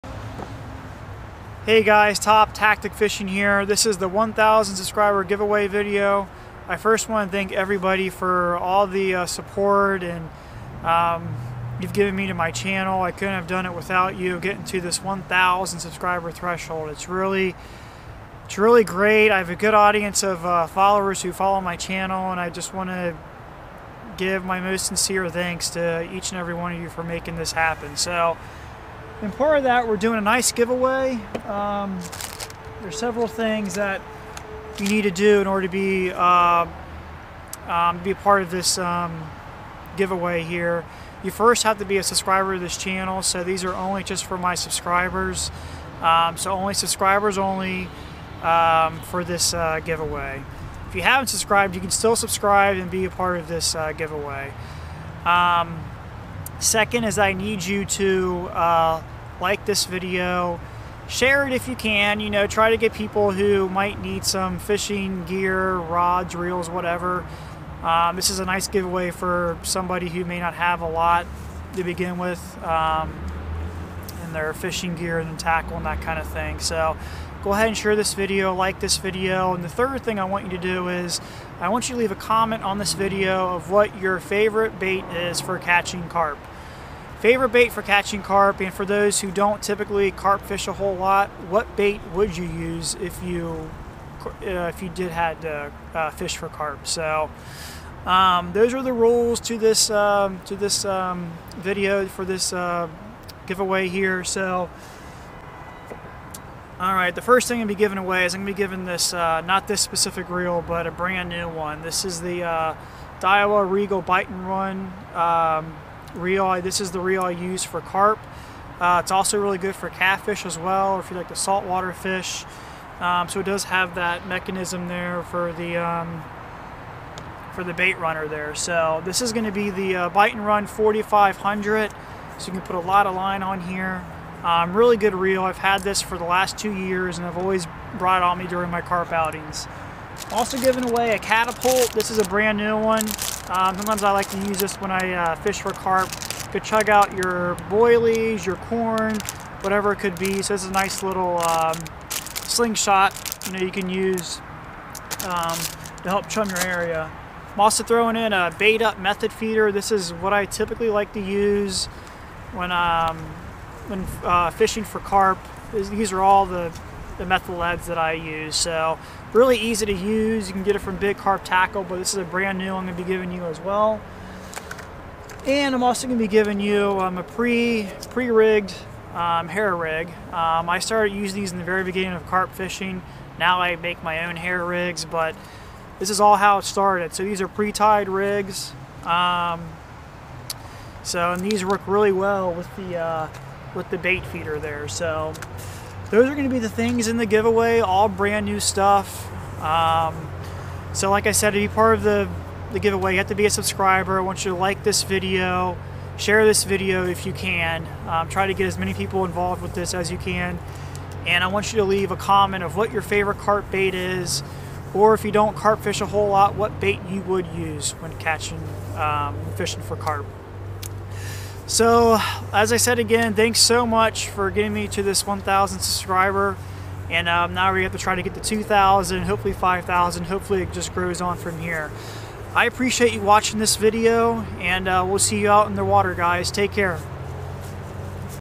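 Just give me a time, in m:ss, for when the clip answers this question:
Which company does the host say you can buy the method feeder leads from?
2:50.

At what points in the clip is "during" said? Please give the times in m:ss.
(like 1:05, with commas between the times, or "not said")
2:18.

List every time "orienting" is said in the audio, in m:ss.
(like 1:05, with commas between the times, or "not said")
not said.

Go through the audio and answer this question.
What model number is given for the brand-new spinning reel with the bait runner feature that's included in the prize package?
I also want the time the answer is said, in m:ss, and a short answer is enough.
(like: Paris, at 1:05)
4500, at 2:10.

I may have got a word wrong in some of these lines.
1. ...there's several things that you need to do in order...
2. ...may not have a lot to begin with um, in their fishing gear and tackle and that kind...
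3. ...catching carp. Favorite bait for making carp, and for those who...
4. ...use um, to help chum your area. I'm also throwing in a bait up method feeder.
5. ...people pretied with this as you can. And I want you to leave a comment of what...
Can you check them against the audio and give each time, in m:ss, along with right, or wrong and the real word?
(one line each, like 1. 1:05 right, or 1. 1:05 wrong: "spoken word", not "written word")
1. 0:32 right
2. 1:10 right
3. 1:25 wrong: "catching", not "making"
4. 2:33 right
5. 3:28 wrong: "involved", not "pretied".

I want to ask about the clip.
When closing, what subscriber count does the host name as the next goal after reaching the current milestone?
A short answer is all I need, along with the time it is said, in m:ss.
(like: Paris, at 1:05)
2,000, at 3:48.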